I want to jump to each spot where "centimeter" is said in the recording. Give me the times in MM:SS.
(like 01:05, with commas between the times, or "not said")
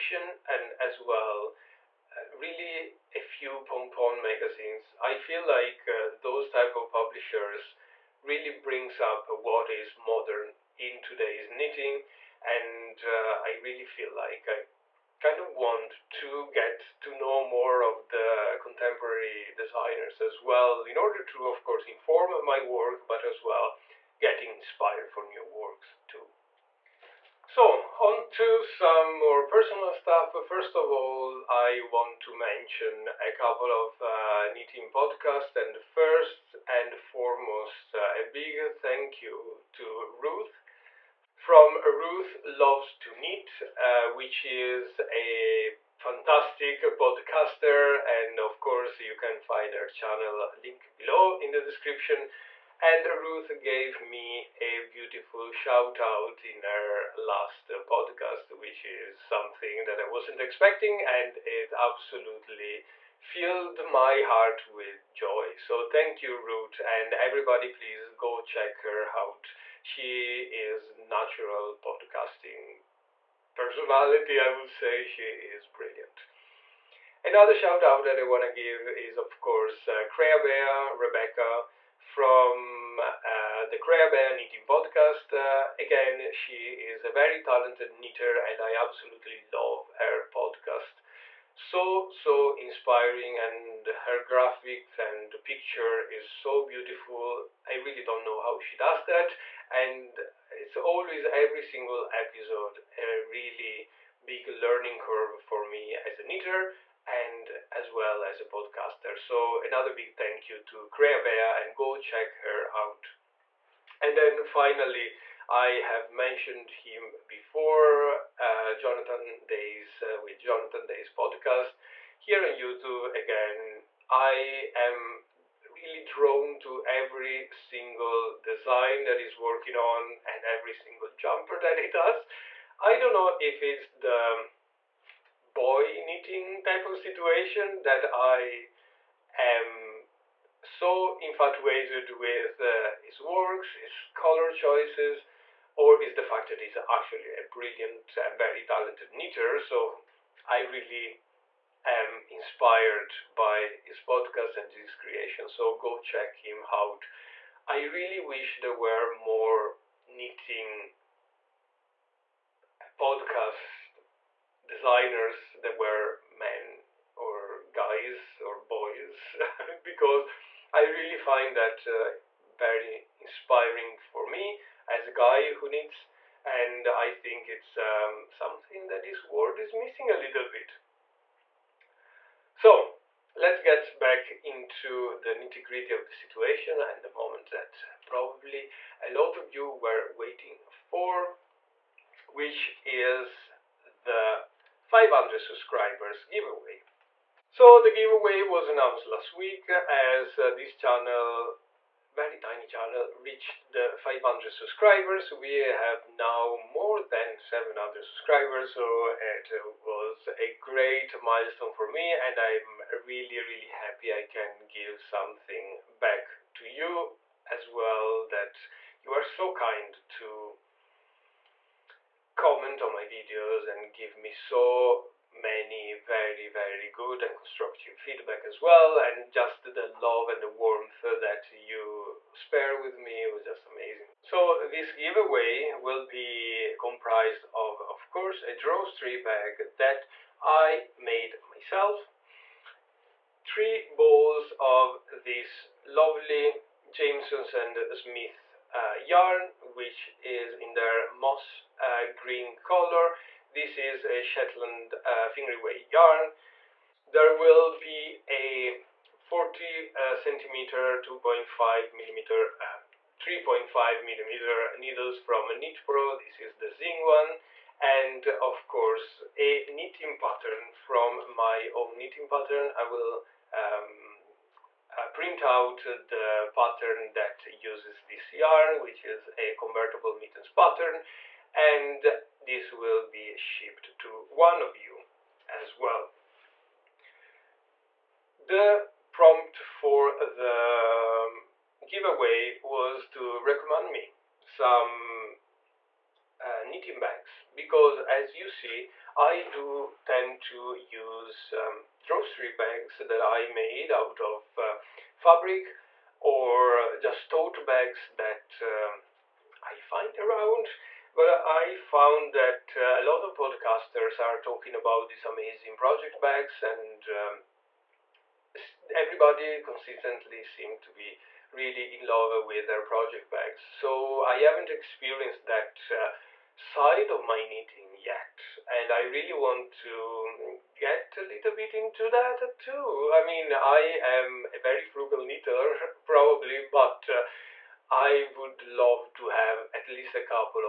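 04:20.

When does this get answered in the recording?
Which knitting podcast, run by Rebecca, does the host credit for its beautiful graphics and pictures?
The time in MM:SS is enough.
01:23.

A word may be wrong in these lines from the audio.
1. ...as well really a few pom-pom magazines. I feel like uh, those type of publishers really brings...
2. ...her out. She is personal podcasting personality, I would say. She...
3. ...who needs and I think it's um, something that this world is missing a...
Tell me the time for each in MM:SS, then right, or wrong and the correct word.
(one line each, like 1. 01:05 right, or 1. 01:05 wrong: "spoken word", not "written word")
1. 00:00 right
2. 01:08 wrong: "natural", not "personal"
3. 02:55 right.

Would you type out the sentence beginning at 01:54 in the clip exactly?
And then finally, I have mentioned him before, uh, Jonathan Days uh, with Jonathan Days podcast here on YouTube.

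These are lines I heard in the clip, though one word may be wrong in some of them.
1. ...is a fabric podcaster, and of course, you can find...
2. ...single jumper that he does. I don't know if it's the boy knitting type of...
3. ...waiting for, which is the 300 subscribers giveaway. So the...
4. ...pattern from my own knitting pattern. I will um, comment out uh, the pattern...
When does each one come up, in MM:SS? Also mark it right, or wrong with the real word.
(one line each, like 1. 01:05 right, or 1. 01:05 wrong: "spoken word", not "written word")
1. 00:44 wrong: "fantastic", not "fabric"
2. 02:10 right
3. 03:10 wrong: "500", not "300"
4. 04:30 wrong: "print", not "comment".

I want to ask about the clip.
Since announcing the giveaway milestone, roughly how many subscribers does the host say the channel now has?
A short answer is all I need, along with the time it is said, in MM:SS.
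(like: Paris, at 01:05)
700, at 03:27.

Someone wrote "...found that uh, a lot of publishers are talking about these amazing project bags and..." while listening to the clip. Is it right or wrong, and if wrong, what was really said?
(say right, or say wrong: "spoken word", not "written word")
wrong: "podcasters", not "publishers".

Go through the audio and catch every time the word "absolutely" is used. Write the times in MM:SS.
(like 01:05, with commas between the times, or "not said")
01:01, 01:28.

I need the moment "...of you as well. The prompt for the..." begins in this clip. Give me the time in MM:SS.
04:44.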